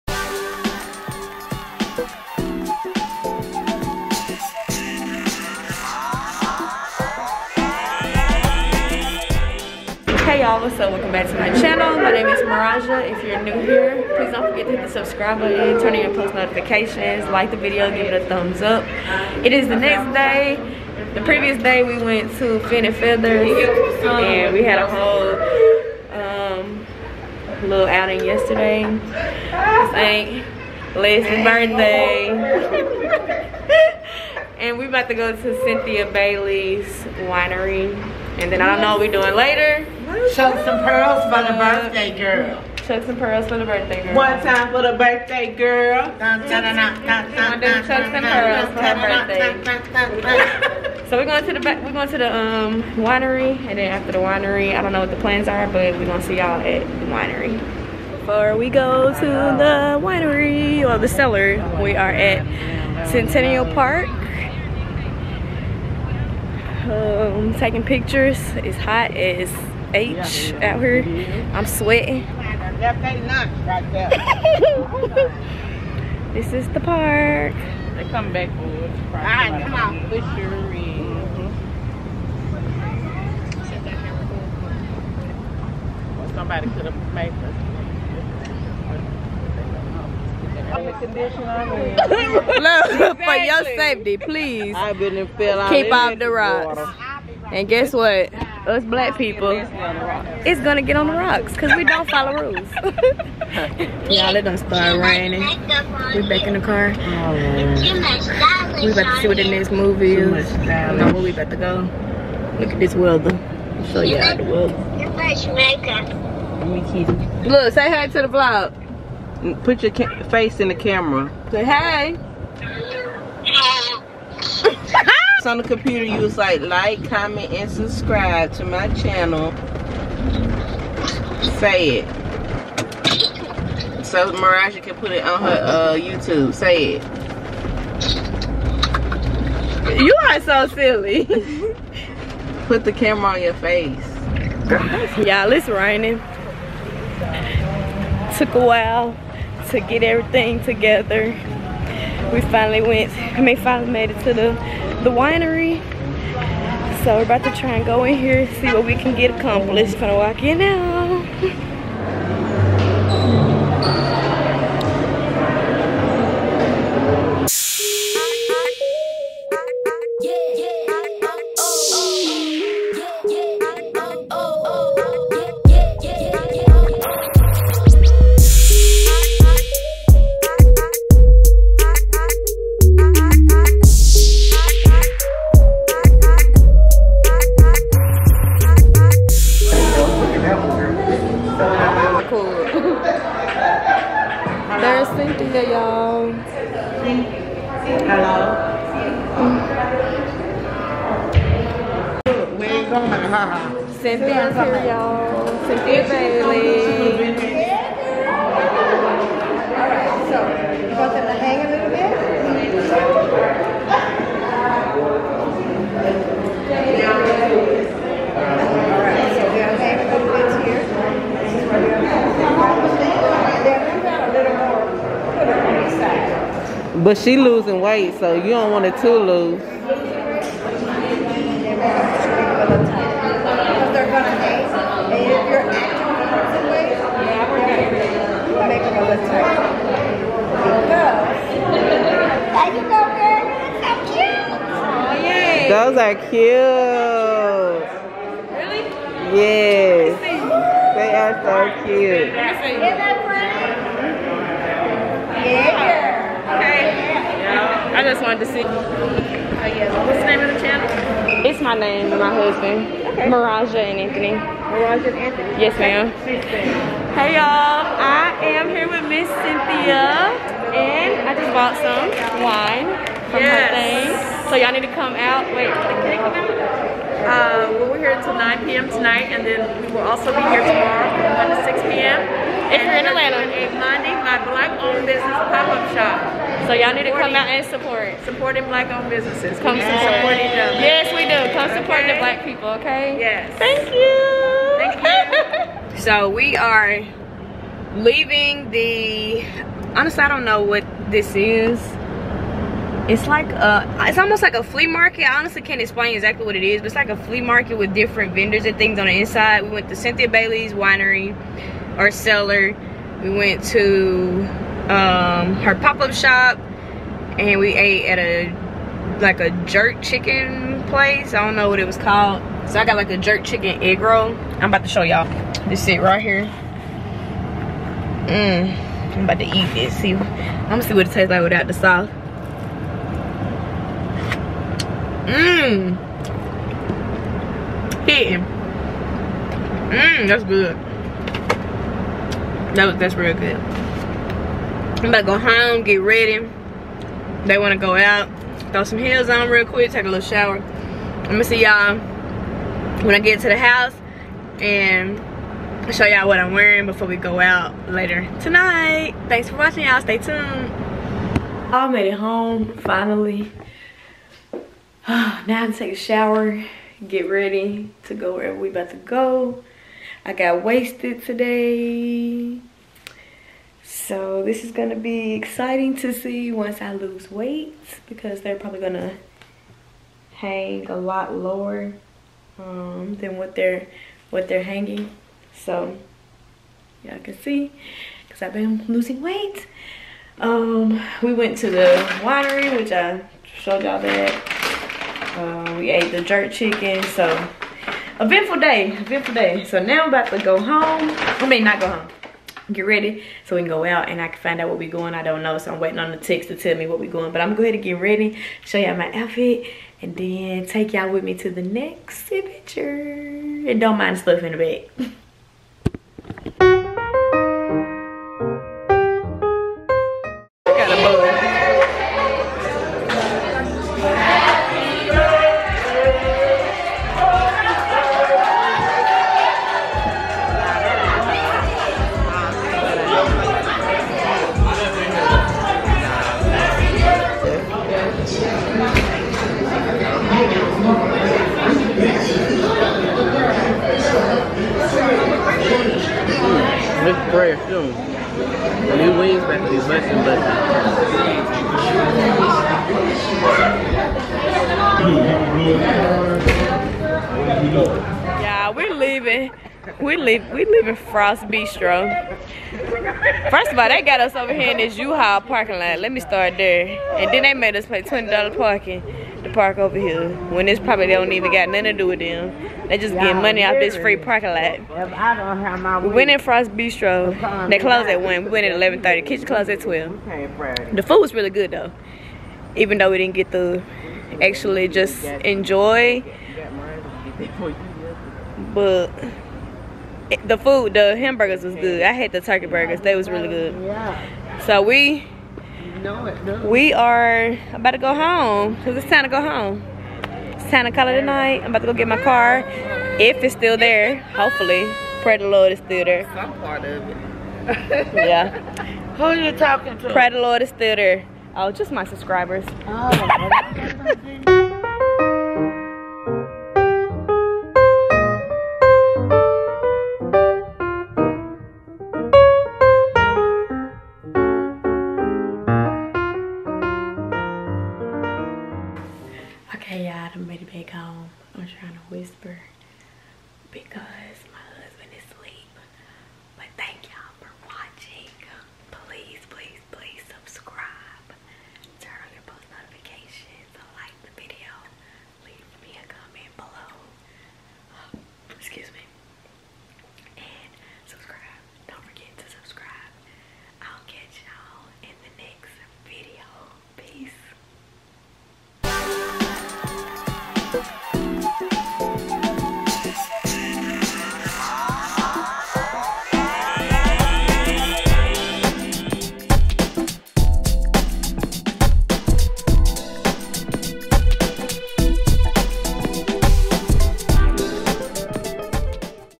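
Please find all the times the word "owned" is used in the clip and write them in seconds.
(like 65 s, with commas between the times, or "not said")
284 s, 288 s.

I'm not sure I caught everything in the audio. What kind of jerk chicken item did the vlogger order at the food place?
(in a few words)
Egg roll.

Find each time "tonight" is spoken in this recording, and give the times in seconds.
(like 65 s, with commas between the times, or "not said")
278 s, 358 s.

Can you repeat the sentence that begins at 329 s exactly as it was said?
See, I'm gonna see what it tastes like without the sauce.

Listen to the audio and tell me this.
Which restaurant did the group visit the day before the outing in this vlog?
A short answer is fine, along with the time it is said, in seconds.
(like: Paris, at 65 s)
Fin and Feathers, at 22 s.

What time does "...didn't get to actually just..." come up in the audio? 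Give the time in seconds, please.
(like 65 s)
483 s.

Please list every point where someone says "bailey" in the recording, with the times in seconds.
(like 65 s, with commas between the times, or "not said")
36 s, 310 s.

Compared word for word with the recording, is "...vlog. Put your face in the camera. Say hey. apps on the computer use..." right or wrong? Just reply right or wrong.
right.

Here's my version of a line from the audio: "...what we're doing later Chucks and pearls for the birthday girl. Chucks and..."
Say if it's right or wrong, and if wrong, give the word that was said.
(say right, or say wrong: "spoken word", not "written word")
right.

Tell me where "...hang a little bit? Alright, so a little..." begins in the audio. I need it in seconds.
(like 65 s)
211 s.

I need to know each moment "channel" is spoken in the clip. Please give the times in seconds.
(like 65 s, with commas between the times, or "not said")
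11 s, 128 s, 260 s.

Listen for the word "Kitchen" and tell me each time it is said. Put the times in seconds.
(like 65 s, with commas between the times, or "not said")
479 s.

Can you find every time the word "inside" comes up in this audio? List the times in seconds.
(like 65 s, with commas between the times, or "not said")
309 s.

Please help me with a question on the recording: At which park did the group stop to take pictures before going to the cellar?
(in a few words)
Centennial Park.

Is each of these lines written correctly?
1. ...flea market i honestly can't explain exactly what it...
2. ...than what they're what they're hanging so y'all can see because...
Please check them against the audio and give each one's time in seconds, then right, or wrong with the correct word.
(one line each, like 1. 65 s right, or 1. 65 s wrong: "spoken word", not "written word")
1. 304 s right
2. 383 s right.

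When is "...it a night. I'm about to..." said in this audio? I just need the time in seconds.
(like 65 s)
501 s.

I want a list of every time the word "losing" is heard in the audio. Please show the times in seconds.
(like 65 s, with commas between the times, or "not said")
227 s, 388 s.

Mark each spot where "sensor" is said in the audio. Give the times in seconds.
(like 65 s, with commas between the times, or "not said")
not said.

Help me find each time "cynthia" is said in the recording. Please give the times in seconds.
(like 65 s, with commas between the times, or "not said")
35 s, 269 s, 309 s.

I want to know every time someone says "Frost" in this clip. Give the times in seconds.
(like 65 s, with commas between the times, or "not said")
460 s, 476 s.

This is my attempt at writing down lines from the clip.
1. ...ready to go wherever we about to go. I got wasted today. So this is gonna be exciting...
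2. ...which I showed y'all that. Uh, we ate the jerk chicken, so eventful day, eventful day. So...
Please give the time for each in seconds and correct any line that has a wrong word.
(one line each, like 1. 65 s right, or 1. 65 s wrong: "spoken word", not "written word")
1. 367 s right
2. 392 s right.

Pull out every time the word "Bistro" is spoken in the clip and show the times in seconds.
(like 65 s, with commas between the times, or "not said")
461 s, 476 s.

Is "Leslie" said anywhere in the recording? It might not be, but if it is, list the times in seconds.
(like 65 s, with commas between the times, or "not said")
30 s.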